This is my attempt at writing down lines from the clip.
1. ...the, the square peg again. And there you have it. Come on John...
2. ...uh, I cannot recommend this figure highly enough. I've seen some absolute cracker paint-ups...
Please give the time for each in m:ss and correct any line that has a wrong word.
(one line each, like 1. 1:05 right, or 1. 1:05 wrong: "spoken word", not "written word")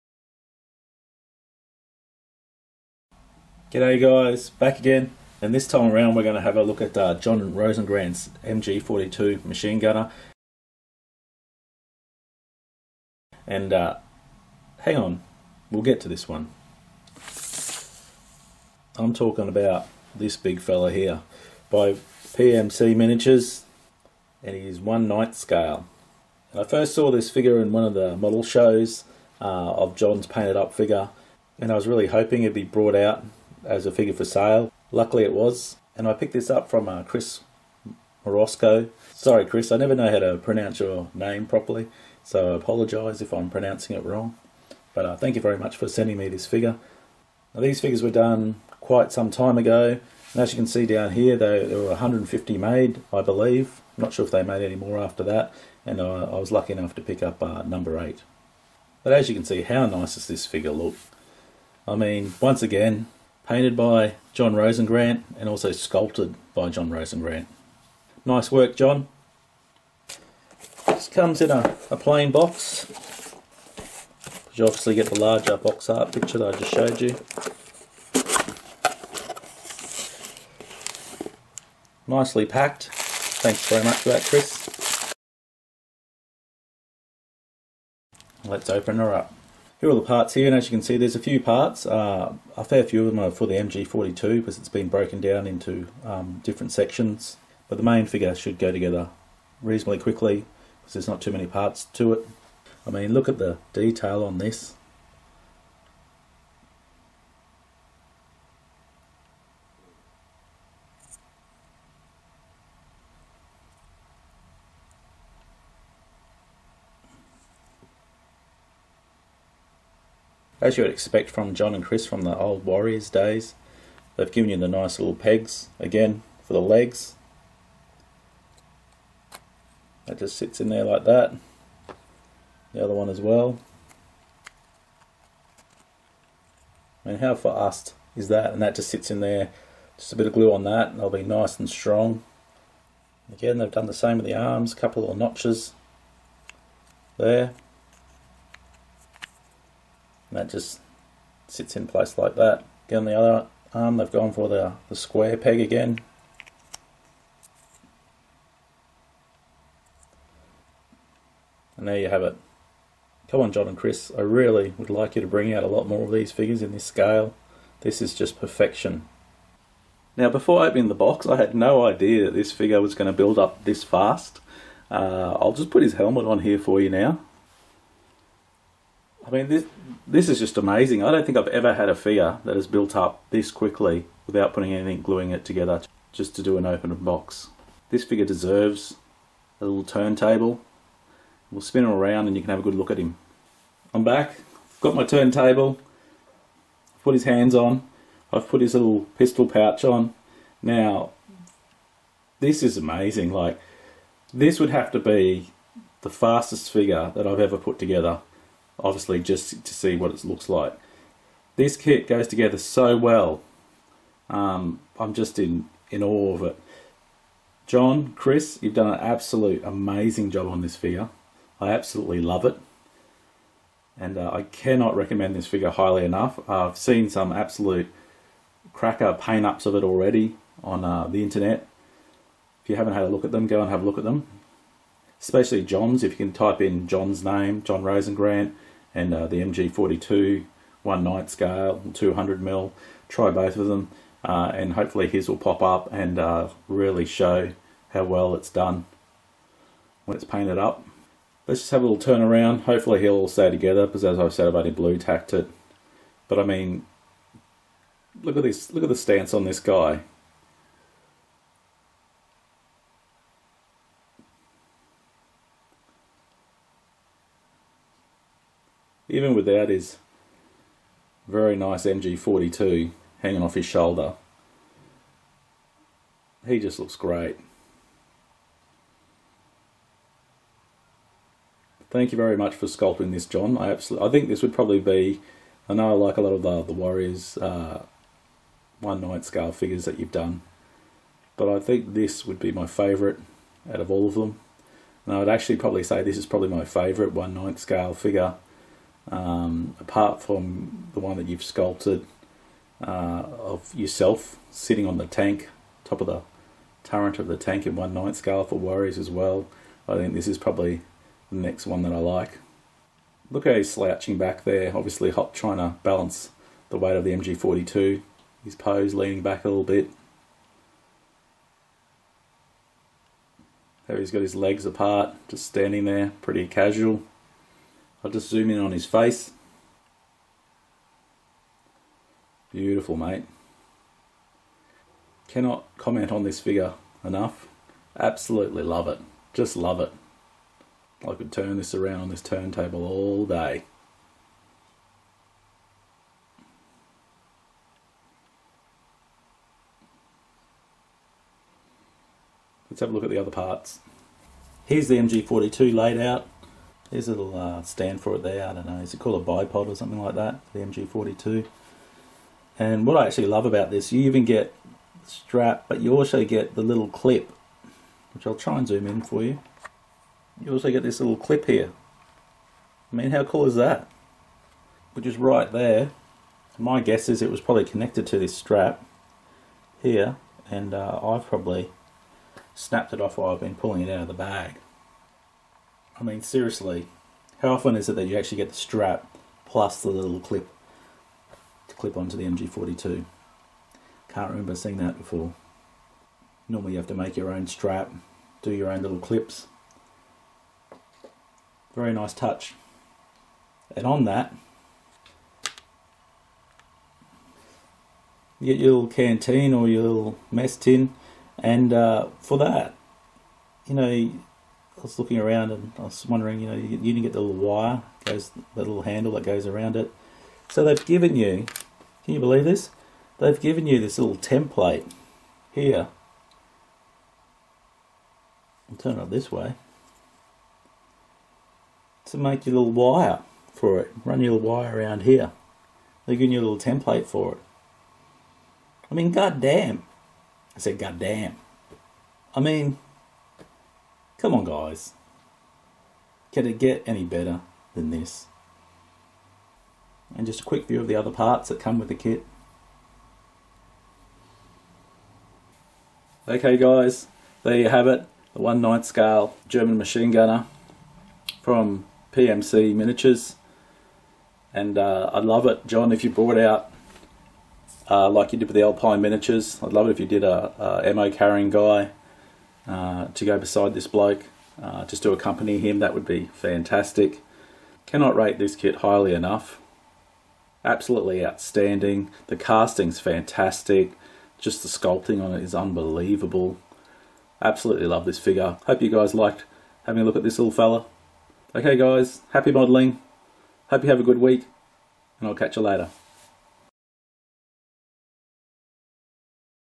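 1. 2:34 right
2. 3:44 right.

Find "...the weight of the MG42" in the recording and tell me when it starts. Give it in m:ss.
5:16.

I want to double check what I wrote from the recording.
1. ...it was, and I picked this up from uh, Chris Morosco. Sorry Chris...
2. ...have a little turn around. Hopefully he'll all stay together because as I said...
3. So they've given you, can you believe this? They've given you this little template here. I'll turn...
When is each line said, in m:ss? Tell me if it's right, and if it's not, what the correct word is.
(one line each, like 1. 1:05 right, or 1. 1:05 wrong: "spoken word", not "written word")
1. 0:35 right
2. 4:11 right
3. 7:00 right.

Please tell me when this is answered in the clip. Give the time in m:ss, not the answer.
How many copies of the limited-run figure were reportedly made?
0:51.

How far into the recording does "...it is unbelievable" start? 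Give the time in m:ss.
8:05.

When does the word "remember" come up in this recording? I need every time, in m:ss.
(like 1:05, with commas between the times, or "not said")
6:34.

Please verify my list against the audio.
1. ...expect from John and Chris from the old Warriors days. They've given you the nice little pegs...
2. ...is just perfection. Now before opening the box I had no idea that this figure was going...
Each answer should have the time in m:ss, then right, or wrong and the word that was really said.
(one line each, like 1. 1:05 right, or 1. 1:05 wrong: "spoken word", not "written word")
1. 2:00 right
2. 2:48 right.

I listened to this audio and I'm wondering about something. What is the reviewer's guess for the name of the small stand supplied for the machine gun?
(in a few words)
Bipod.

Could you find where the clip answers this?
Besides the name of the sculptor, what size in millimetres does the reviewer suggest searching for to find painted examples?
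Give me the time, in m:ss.
4:01.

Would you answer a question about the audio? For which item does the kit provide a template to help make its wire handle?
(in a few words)
Mess tin.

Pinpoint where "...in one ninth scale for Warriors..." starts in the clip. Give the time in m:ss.
5:07.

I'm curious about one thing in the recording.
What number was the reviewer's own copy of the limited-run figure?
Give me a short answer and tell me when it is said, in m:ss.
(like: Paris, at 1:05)
8, at 0:57.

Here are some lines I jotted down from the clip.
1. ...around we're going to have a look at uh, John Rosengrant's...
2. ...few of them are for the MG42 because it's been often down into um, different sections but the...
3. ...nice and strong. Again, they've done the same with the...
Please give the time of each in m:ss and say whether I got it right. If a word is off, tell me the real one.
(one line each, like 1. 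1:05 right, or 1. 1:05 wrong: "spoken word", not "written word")
1. 0:05 right
2. 1:32 wrong: "broken", not "often"
3. 2:21 right.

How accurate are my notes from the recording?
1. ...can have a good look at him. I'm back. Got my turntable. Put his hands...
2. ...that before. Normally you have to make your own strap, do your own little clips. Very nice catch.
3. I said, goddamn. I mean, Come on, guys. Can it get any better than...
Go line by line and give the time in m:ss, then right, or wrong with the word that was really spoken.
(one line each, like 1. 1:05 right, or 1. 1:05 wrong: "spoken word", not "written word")
1. 3:12 right
2. 6:34 wrong: "touch", not "catch"
3. 7:20 right.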